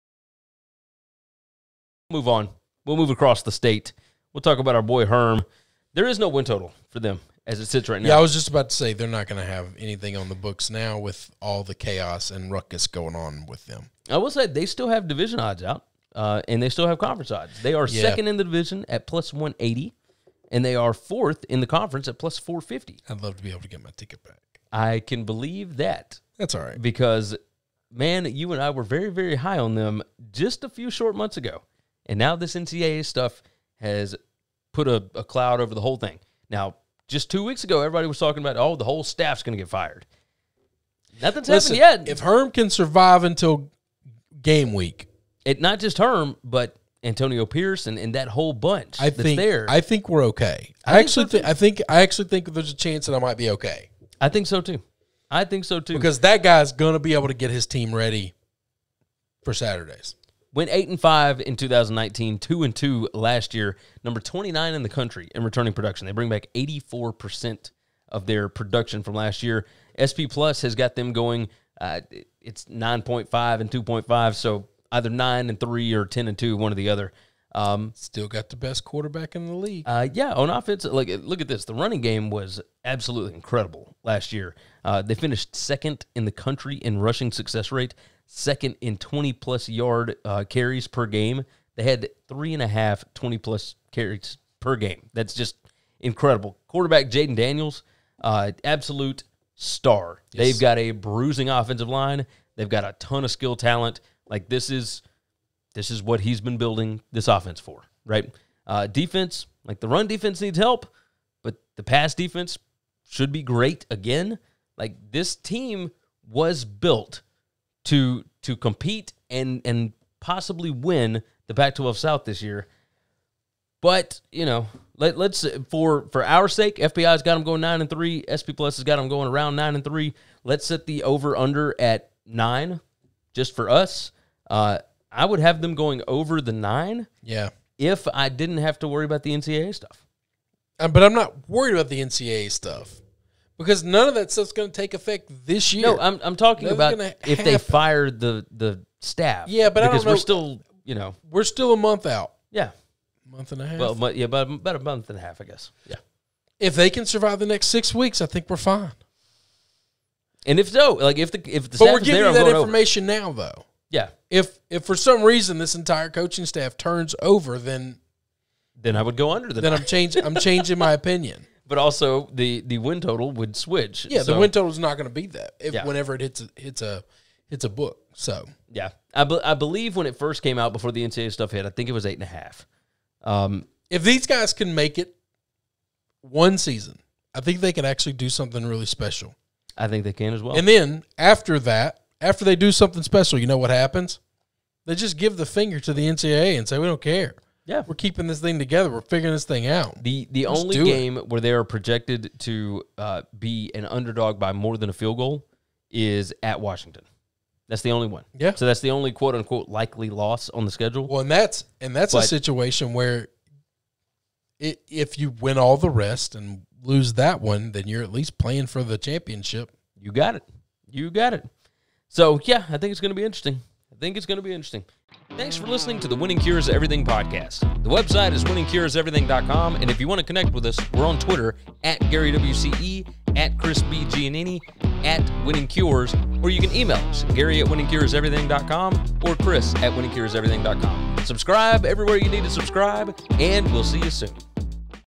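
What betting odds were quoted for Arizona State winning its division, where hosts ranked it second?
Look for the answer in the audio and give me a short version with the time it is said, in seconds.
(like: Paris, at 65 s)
+180, at 19 s.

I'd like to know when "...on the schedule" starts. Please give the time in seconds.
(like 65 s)
210 s.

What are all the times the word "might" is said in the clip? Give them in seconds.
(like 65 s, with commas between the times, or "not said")
53 s.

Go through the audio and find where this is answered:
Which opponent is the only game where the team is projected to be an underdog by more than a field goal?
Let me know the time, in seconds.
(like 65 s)
206 s.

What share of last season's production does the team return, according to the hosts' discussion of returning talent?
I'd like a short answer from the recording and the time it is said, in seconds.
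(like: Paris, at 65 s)
84%, at 66 s.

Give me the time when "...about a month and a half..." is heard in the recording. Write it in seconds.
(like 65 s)
154 s.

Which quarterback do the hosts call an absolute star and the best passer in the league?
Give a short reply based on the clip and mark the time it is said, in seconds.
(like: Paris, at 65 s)
Jayden Daniels, at 97 s.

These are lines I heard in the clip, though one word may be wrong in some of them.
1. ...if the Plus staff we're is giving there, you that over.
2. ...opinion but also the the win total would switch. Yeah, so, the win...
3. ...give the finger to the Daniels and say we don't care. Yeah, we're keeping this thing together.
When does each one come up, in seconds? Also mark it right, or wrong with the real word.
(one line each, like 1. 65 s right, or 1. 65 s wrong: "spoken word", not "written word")
1. 161 s wrong: "But", not "Plus"
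2. 170 s right
3. 195 s wrong: "NCAA", not "Daniels".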